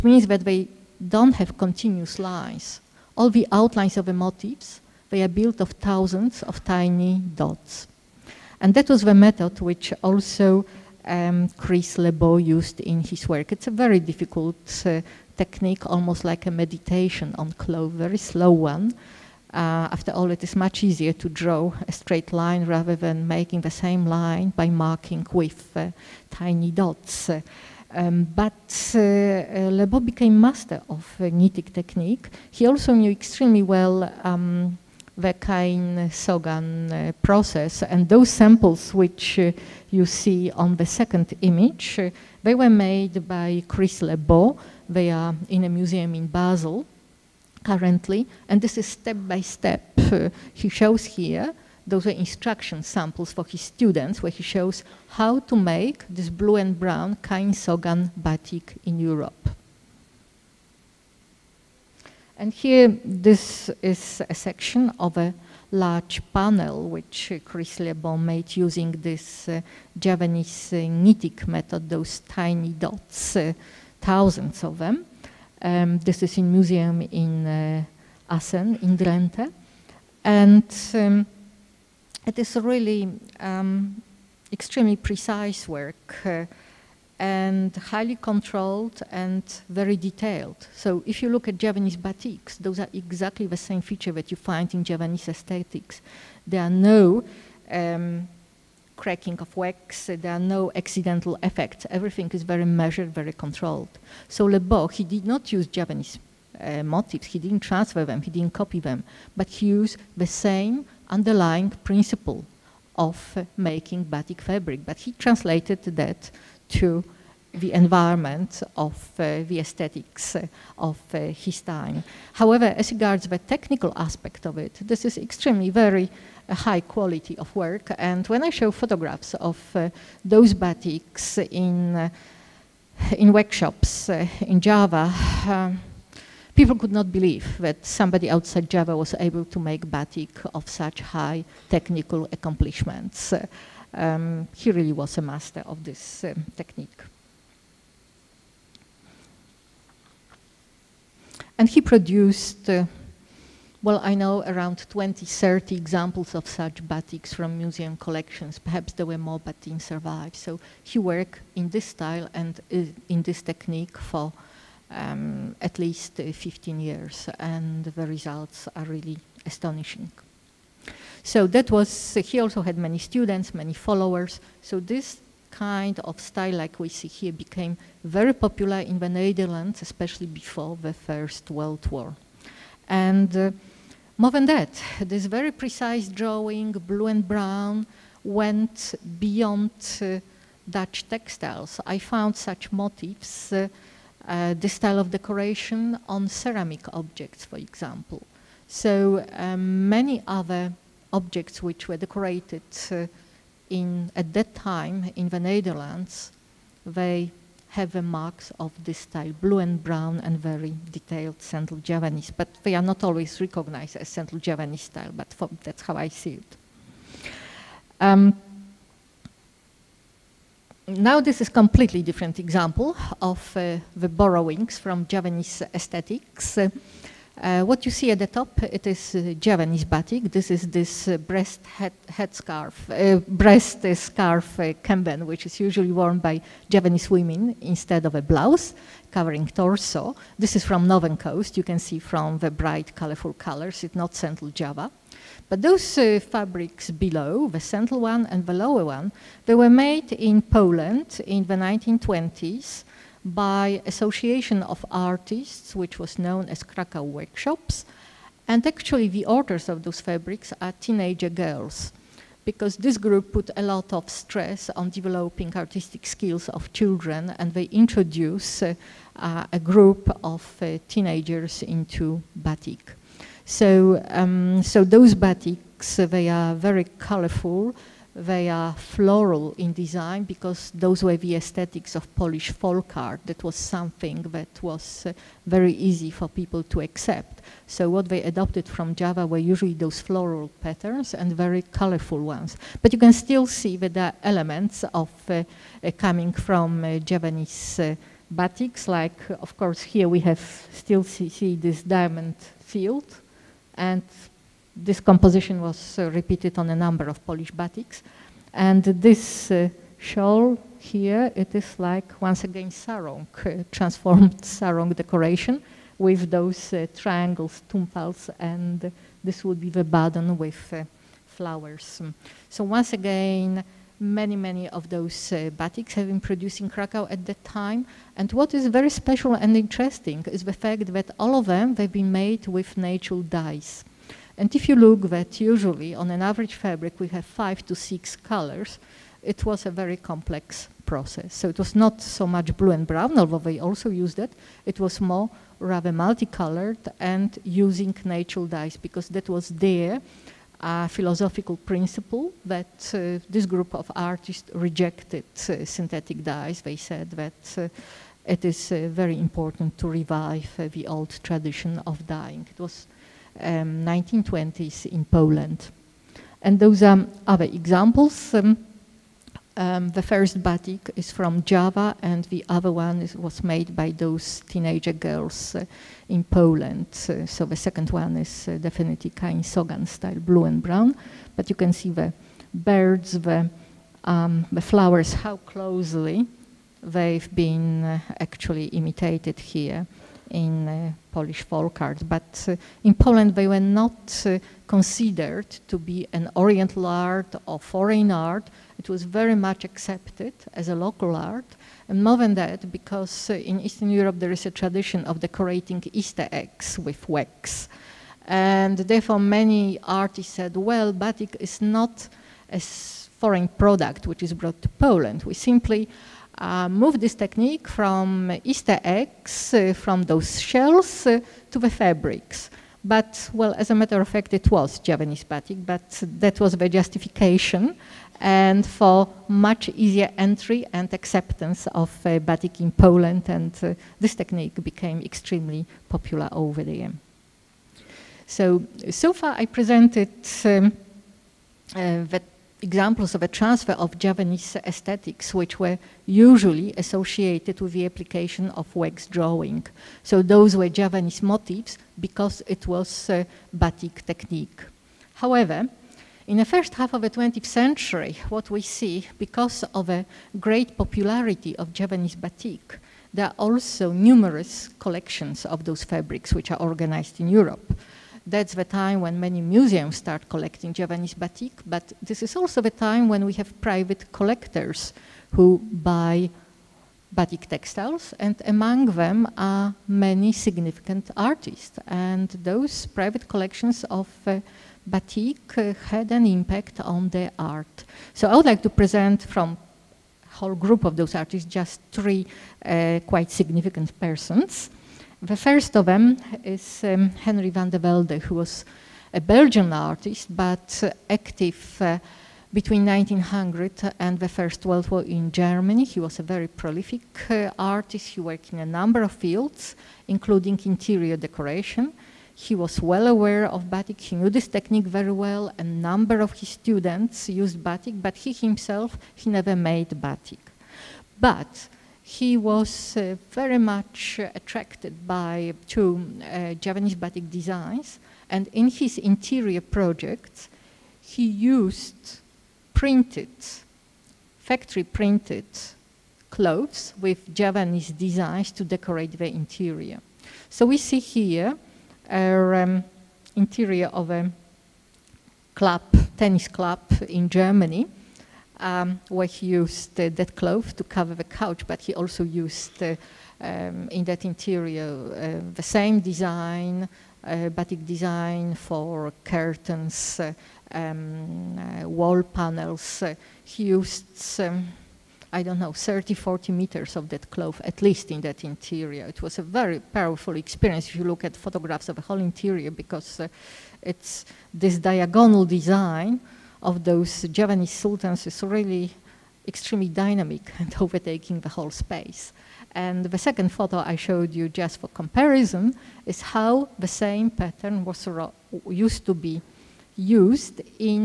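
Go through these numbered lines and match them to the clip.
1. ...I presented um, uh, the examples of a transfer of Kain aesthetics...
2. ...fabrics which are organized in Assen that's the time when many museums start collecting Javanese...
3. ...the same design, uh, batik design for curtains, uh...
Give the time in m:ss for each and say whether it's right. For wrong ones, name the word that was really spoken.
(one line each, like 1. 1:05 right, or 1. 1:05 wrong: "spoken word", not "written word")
1. 7:19 wrong: "Javanese", not "Kain"
2. 7:45 wrong: "Europe", not "Assen"
3. 9:15 right.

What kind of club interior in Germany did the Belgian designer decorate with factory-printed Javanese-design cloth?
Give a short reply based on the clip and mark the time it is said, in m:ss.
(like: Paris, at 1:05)
Tennis club, at 9:06.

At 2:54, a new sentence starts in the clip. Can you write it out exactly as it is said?
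So this kind of style like we see here became very popular in the Netherlands, especially before the First World War.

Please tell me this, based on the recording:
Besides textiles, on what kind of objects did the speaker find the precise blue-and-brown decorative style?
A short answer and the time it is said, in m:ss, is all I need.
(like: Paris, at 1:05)
Ceramic objects, at 3:16.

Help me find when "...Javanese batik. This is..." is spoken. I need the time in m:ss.
3:49.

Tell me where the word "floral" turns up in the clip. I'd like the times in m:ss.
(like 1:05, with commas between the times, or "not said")
4:38, 4:50.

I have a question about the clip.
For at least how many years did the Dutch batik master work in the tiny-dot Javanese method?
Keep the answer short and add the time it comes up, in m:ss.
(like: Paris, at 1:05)
15, at 2:46.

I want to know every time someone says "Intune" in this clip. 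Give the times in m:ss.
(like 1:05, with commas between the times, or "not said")
not said.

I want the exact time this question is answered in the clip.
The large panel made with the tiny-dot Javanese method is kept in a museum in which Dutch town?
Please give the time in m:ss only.
1:18.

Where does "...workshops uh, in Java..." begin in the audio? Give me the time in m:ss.
2:13.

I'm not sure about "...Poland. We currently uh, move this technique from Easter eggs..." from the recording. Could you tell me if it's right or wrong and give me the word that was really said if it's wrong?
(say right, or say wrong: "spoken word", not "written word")
wrong: "simply", not "currently".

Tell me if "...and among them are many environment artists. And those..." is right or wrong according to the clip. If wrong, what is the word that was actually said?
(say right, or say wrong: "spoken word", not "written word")
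wrong: "significant", not "environment".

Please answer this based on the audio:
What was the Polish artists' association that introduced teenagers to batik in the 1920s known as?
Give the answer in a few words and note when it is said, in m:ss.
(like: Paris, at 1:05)
Krakow Workshops, at 4:16.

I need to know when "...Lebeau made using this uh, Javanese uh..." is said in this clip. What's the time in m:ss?
1:07.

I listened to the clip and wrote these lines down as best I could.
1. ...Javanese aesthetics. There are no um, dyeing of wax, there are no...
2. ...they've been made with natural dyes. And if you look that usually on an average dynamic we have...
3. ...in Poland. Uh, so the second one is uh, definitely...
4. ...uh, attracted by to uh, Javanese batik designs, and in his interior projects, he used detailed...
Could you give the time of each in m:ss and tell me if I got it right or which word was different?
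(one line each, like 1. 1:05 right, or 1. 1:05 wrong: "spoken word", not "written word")
1. 1:34 wrong: "cracking", not "dyeing"
2. 5:31 wrong: "fabric", not "dynamic"
3. 6:16 right
4. 8:44 wrong: "printed", not "detailed".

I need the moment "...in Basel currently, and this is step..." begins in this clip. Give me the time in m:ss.
0:46.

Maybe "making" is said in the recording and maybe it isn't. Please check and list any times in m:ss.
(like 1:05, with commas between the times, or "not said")
0:23, 1:53.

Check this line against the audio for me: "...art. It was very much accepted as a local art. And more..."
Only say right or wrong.
right.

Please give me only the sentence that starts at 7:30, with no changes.
So those were Javanese motifs because it was batik technique.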